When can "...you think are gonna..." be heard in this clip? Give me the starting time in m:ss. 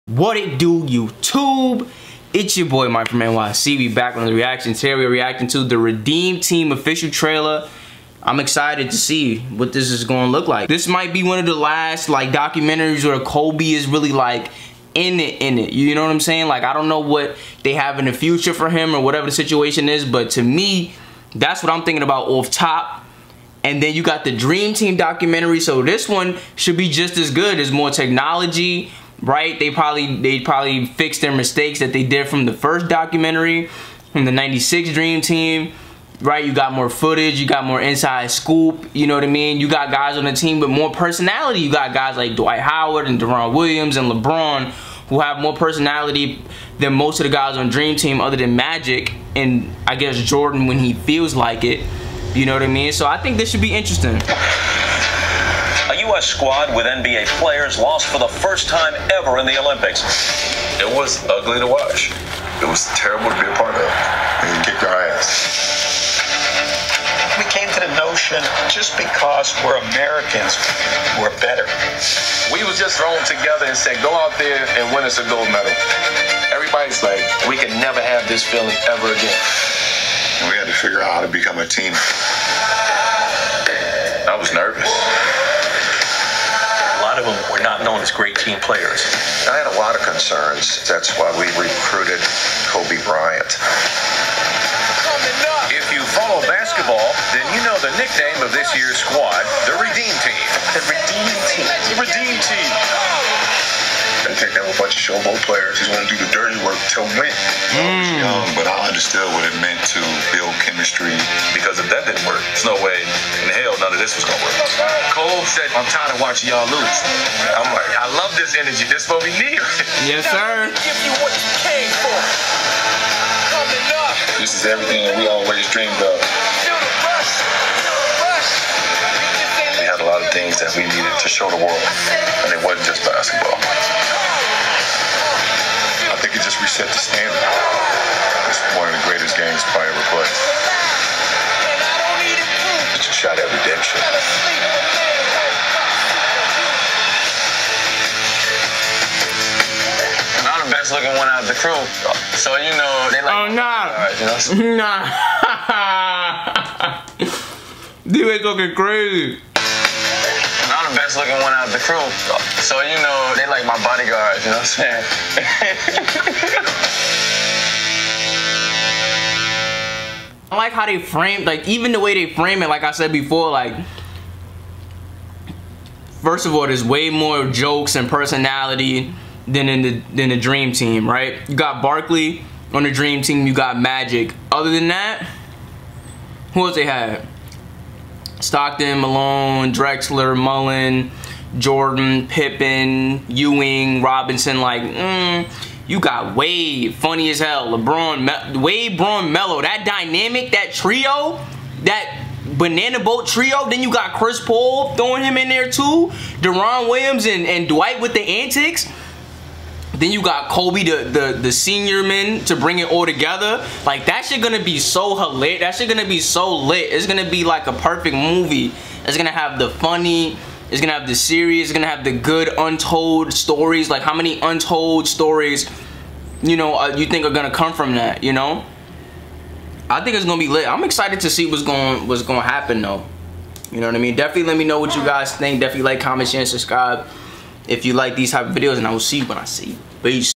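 3:46.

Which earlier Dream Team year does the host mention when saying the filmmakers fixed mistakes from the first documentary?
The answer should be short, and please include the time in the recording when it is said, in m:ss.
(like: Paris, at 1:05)
1996, at 0:34.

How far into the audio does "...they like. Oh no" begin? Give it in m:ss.
2:33.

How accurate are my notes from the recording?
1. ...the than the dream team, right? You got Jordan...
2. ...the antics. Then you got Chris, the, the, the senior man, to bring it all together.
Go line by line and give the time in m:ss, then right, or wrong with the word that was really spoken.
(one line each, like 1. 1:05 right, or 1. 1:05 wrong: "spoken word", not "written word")
1. 2:59 wrong: "Barkley", not "Jordan"
2. 3:28 wrong: "Kobe", not "Chris".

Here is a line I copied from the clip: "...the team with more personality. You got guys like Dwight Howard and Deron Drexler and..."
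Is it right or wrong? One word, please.
wrong.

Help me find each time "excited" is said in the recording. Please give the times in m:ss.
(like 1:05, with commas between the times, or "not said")
0:08, 3:50.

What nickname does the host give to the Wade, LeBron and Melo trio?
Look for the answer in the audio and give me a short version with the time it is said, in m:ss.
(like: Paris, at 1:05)
banana boat trio, at 3:22.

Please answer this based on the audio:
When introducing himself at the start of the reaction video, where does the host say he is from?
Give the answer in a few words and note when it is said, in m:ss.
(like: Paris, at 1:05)
NYC, at 0:03.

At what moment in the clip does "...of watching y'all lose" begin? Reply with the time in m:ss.
1:56.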